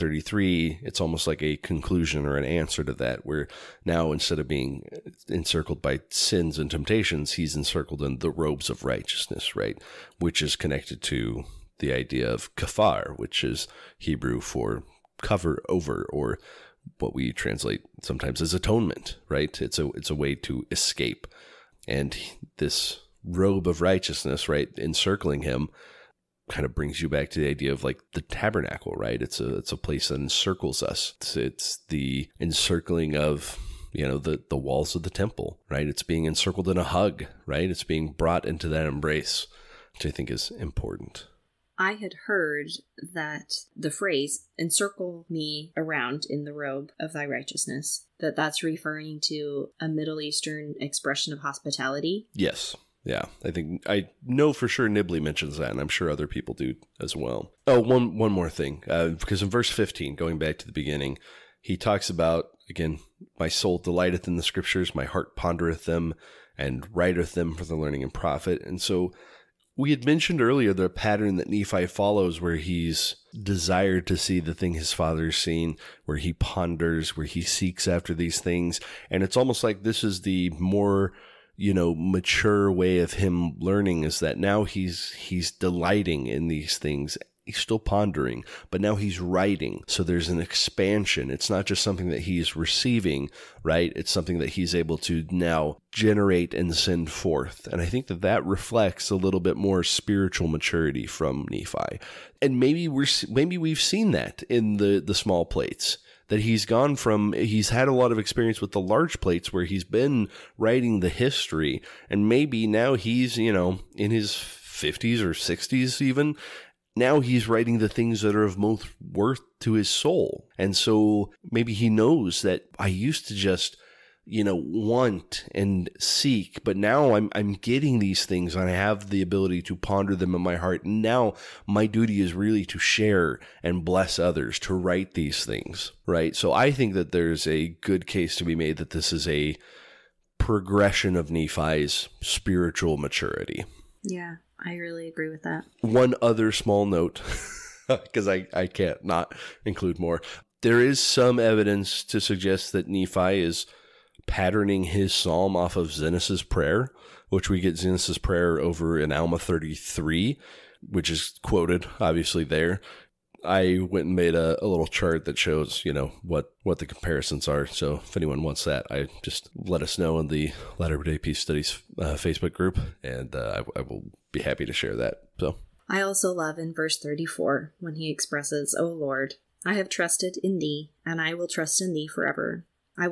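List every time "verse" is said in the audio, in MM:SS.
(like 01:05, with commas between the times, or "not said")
00:59, 02:56.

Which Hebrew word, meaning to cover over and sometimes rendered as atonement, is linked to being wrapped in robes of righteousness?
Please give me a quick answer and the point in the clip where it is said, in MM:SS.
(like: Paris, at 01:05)
kafar, at 00:12.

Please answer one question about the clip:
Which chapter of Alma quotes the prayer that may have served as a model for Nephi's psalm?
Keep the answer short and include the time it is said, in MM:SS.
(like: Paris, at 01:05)
Alma 33, at 02:39.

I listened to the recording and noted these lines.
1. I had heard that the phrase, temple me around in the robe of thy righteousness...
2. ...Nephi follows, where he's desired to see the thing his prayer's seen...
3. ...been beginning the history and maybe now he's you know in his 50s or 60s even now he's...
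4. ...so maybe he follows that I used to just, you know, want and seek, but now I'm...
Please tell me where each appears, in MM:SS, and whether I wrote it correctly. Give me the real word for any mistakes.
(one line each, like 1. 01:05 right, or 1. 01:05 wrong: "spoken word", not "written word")
1. 00:41 wrong: "encircle", not "temple"
2. 01:11 wrong: "father", not "prayer"
3. 01:49 wrong: "writing", not "beginning"
4. 02:00 wrong: "knows", not "follows".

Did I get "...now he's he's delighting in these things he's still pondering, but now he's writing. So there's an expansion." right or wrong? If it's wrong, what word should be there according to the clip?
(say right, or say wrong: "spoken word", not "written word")
right.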